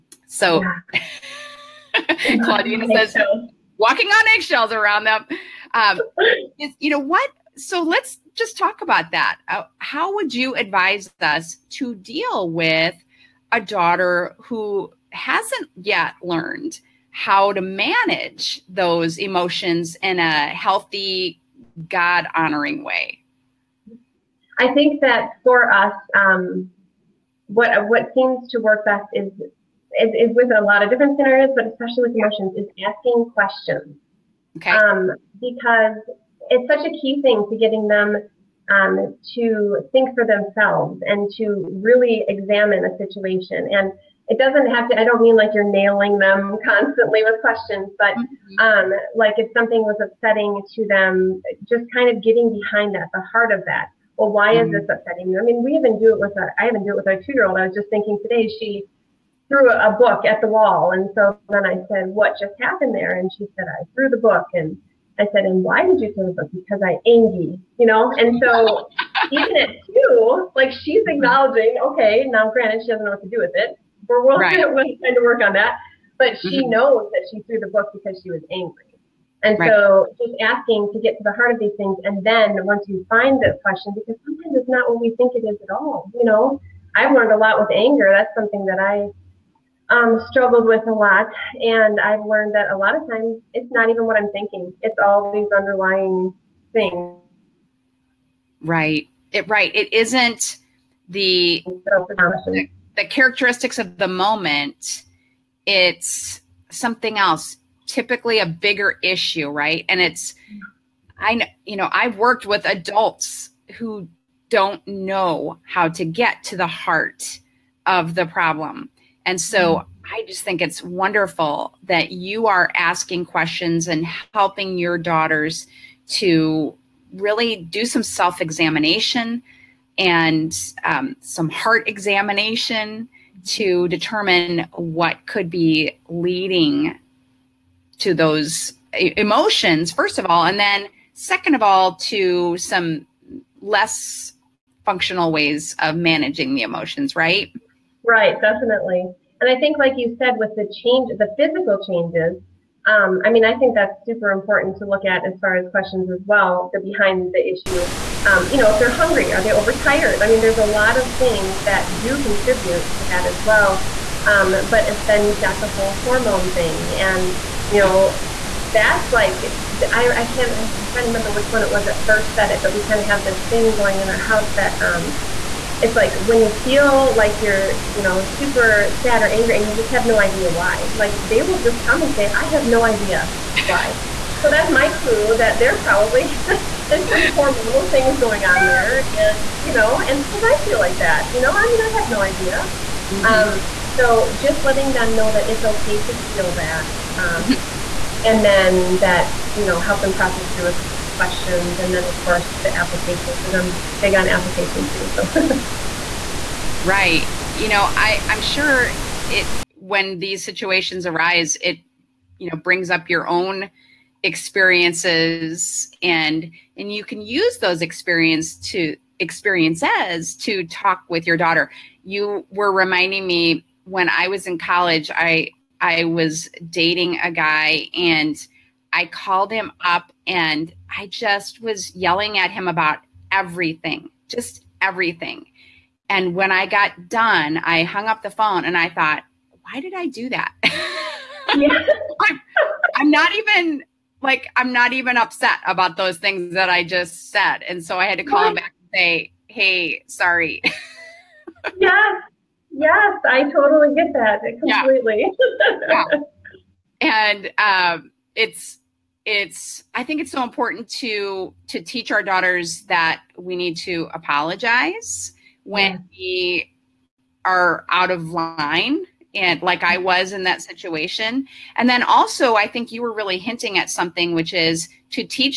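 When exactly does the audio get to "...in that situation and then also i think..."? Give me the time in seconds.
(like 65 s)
270 s.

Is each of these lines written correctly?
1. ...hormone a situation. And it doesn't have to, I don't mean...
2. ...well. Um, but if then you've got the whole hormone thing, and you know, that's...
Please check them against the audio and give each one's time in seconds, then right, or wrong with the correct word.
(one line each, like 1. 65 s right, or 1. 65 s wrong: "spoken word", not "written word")
1. 42 s wrong: "examine", not "hormone"
2. 163 s right.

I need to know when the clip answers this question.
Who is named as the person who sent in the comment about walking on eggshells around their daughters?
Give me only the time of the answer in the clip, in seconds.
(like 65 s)
2 s.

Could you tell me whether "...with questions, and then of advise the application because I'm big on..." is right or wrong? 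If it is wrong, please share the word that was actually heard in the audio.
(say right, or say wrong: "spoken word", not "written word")
wrong: "course", not "advise".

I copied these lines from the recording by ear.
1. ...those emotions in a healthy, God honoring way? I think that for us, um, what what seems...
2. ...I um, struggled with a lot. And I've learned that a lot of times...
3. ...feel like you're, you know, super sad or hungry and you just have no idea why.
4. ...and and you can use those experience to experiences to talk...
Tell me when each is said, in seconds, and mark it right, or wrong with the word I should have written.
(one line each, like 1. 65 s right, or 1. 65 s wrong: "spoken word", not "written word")
1. 18 s right
2. 88 s right
3. 176 s wrong: "angry", not "hungry"
4. 216 s right.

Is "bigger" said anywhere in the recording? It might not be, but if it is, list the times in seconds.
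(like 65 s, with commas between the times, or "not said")
108 s.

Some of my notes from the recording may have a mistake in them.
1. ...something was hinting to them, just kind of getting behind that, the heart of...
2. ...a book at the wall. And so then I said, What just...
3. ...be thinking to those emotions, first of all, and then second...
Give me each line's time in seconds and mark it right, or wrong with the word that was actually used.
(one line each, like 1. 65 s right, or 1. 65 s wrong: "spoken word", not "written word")
1. 49 s wrong: "upsetting", not "hinting"
2. 59 s right
3. 135 s wrong: "leading", not "thinking".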